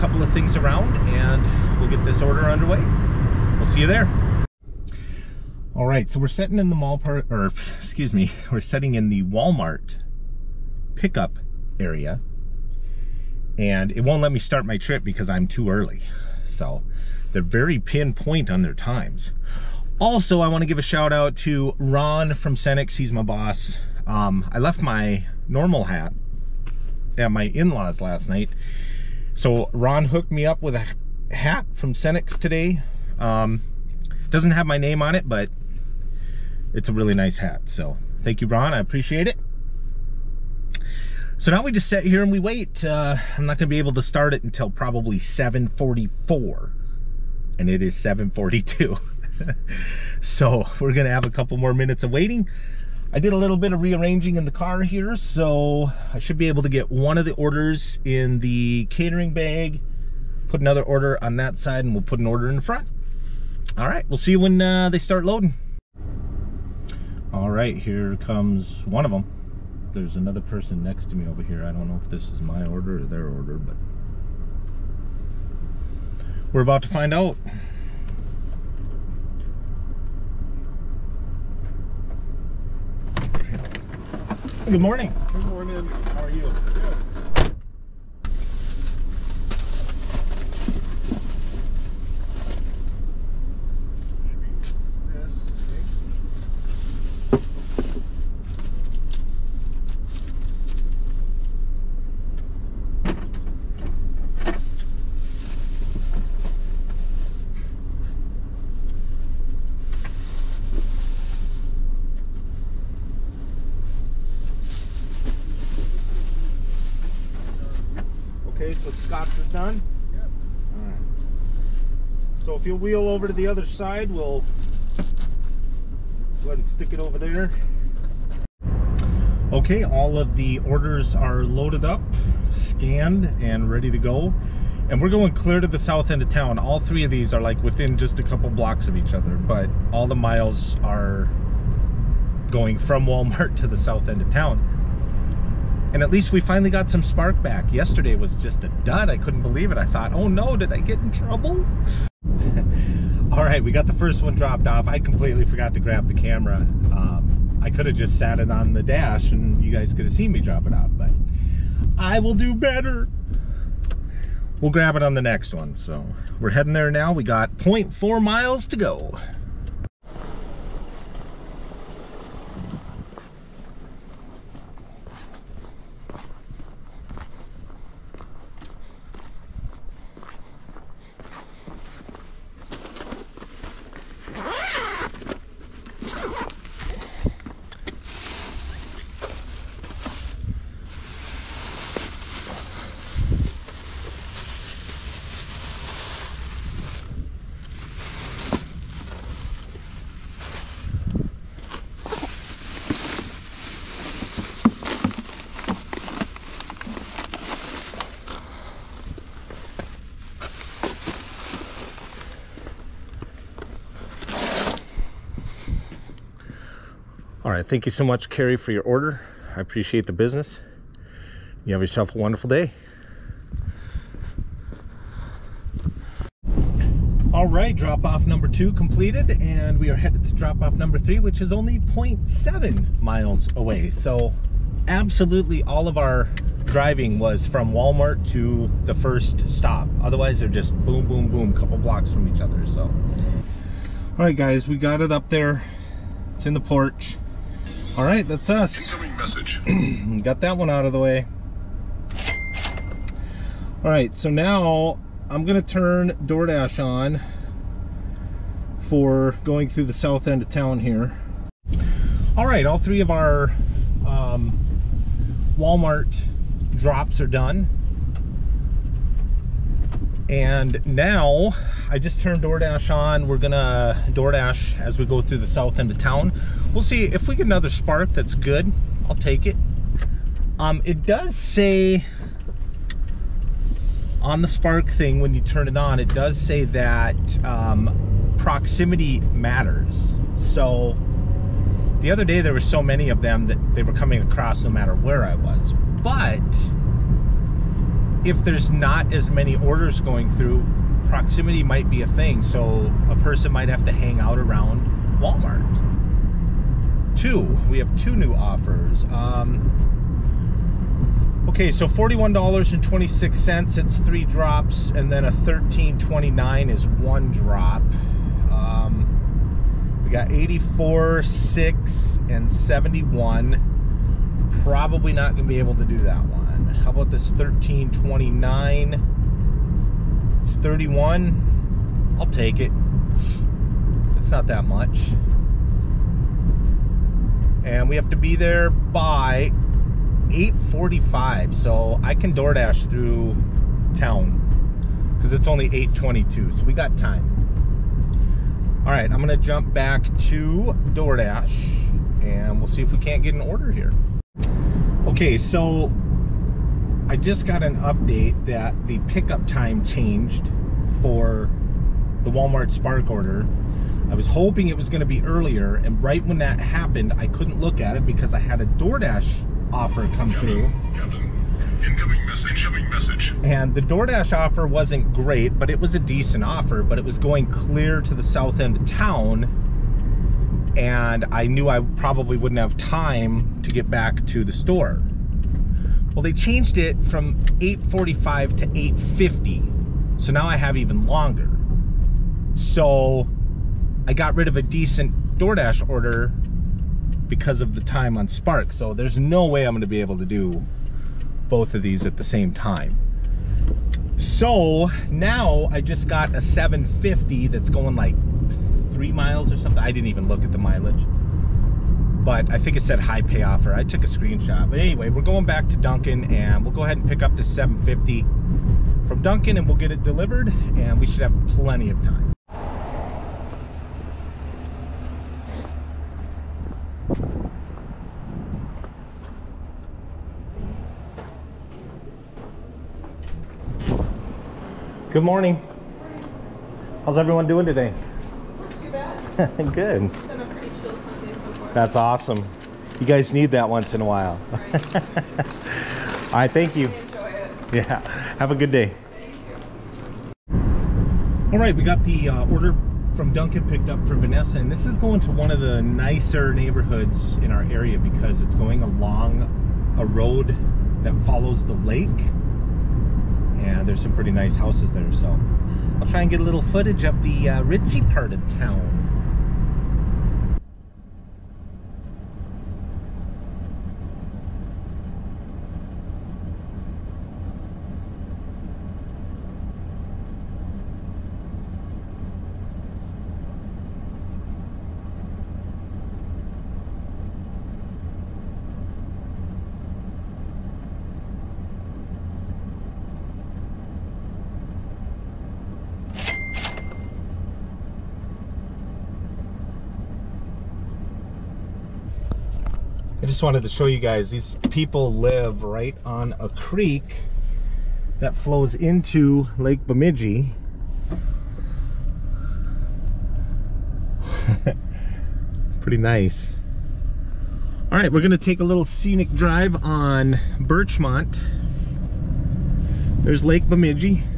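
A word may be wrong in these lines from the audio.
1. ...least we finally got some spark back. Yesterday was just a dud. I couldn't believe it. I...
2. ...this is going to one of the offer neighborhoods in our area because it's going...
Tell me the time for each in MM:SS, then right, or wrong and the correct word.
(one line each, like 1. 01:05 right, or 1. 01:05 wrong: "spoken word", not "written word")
1. 02:26 right
2. 07:34 wrong: "nicer", not "offer".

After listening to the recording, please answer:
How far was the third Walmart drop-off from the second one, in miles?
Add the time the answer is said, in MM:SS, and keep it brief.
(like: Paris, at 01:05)
0.7 miles, at 03:51.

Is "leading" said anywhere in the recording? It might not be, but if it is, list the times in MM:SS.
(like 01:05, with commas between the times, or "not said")
not said.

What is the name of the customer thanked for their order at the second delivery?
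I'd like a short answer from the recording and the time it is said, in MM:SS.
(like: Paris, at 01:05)
Carrie, at 03:38.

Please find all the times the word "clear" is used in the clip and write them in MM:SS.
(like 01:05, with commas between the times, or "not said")
02:15, 06:17.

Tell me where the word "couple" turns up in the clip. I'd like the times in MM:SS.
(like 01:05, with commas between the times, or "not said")
00:51, 02:18, 04:01.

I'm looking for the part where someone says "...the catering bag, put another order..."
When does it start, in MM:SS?
00:58.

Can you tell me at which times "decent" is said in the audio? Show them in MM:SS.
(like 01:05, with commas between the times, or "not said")
06:15, 06:34.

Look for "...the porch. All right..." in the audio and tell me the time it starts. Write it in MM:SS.
04:06.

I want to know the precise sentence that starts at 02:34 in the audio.
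I completely forgot to grab the camera.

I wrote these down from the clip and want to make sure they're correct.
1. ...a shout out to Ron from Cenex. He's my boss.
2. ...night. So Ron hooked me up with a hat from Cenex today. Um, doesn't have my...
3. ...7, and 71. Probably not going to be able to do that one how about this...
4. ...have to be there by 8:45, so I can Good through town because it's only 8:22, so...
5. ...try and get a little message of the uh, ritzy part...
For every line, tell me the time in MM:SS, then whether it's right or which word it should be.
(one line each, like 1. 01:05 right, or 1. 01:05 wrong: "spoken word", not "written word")
1. 00:20 right
2. 00:28 right
3. 05:21 wrong: "6", not "7"
4. 05:37 wrong: "DoorDash", not "Good"
5. 07:46 wrong: "footage", not "message".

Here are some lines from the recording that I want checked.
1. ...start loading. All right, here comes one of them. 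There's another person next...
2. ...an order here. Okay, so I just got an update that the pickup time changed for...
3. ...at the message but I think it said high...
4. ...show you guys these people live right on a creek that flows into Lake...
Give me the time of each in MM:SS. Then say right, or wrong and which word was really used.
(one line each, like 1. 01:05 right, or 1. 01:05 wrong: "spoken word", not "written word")
1. 01:04 right
2. 05:53 right
3. 06:50 wrong: "mileage", not "message"
4. 08:23 right.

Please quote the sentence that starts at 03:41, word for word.
You have yourself a wonderful day.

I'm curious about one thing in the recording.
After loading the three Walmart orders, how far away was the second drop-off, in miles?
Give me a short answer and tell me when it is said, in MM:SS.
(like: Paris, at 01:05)
0.4 miles, at 02:47.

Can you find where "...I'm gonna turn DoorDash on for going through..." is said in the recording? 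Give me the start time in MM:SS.
04:15.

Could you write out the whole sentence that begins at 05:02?
So a person might have to hang out around Walmart.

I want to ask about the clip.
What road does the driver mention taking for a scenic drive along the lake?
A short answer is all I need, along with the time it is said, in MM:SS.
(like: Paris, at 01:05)
Birchmont, at 08:40.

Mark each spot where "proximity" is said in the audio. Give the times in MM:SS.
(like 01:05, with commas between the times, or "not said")
04:48, 05:01.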